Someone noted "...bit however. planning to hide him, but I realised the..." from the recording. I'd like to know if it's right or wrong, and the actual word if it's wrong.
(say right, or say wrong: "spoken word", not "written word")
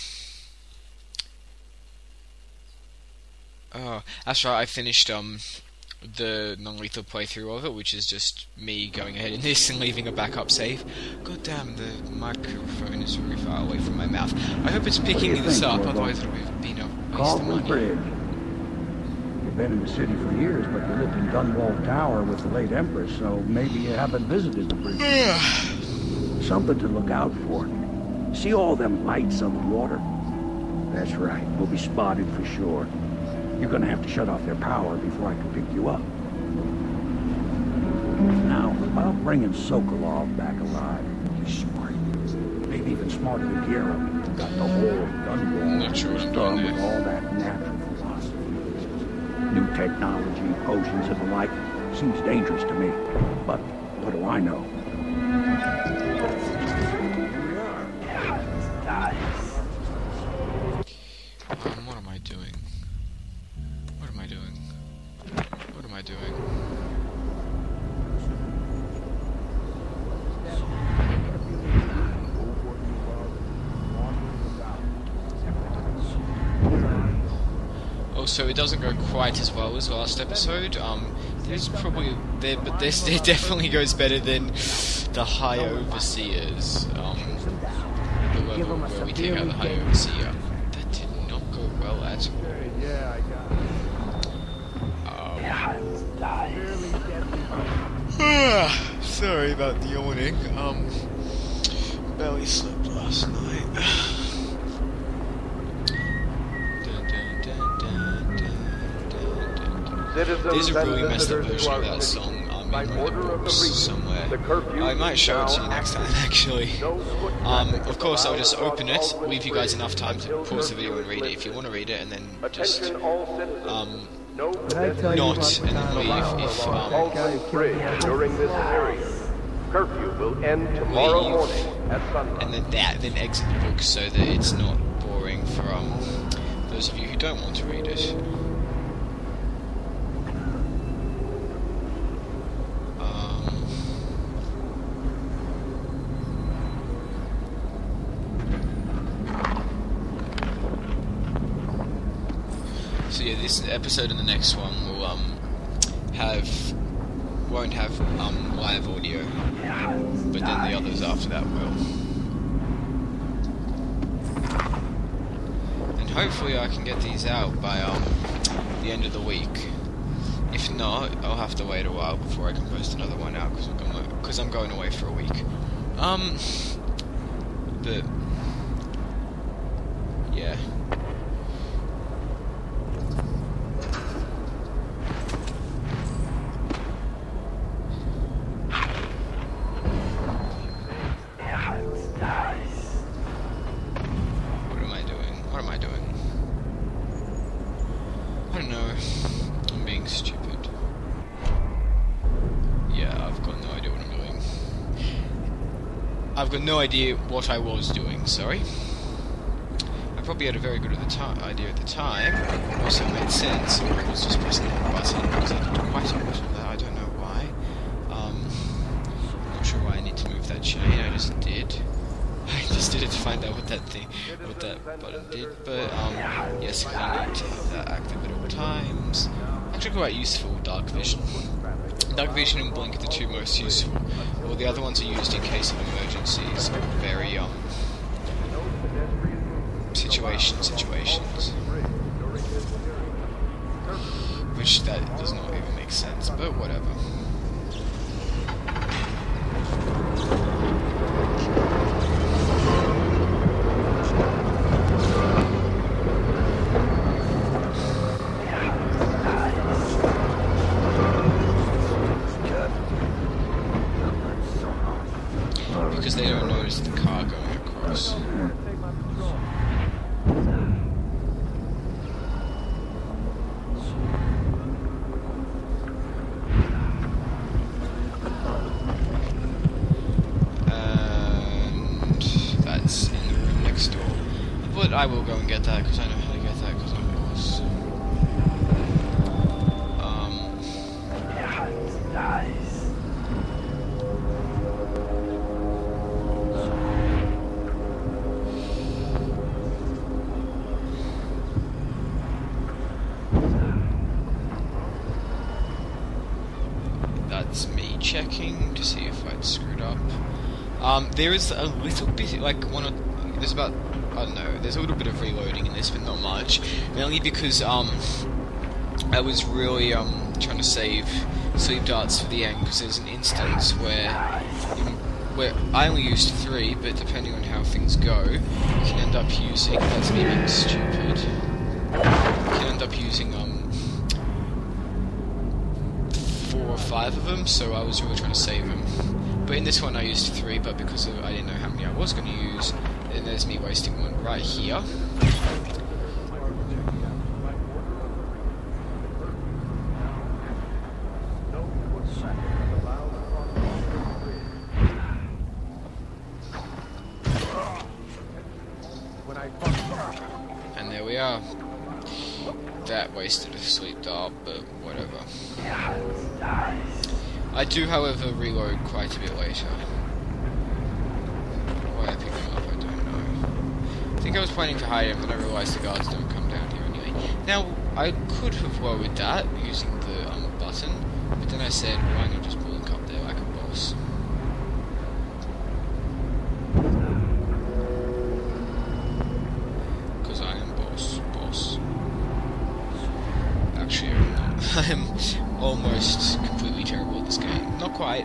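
wrong: "later", not "however".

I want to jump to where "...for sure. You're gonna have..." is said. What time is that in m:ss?
0:32.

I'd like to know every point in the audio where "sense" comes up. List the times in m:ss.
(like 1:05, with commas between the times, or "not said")
3:33, 4:05.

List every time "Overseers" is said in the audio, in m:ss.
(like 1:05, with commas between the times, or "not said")
1:25, 1:29.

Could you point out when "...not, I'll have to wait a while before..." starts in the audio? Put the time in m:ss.
2:50.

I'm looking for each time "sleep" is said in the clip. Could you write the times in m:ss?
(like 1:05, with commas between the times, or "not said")
5:21, 6:03.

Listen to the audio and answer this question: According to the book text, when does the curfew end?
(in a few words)
tomorrow morning at sunrise.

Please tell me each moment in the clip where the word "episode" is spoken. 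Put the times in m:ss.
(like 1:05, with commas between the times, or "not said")
1:20, 2:33.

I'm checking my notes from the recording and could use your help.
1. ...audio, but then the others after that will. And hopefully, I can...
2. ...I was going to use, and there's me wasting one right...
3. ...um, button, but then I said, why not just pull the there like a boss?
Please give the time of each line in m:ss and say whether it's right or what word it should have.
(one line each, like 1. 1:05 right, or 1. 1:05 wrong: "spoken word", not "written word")
1. 2:38 right
2. 5:41 right
3. 6:20 right.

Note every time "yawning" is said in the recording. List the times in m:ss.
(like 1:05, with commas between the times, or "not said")
1:39.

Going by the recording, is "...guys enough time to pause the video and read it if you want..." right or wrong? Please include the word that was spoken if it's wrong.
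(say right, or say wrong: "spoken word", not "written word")
right.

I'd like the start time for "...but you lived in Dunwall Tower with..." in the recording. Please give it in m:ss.
0:20.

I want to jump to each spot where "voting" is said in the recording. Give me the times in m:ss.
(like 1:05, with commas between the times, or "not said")
not said.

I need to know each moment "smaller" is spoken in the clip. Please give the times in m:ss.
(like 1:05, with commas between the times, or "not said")
not said.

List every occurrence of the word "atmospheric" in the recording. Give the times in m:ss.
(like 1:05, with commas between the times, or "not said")
not said.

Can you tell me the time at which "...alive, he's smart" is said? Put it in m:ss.
0:40.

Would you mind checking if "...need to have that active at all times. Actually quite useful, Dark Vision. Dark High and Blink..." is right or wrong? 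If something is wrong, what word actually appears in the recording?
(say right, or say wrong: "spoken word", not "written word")
wrong: "Vision", not "High".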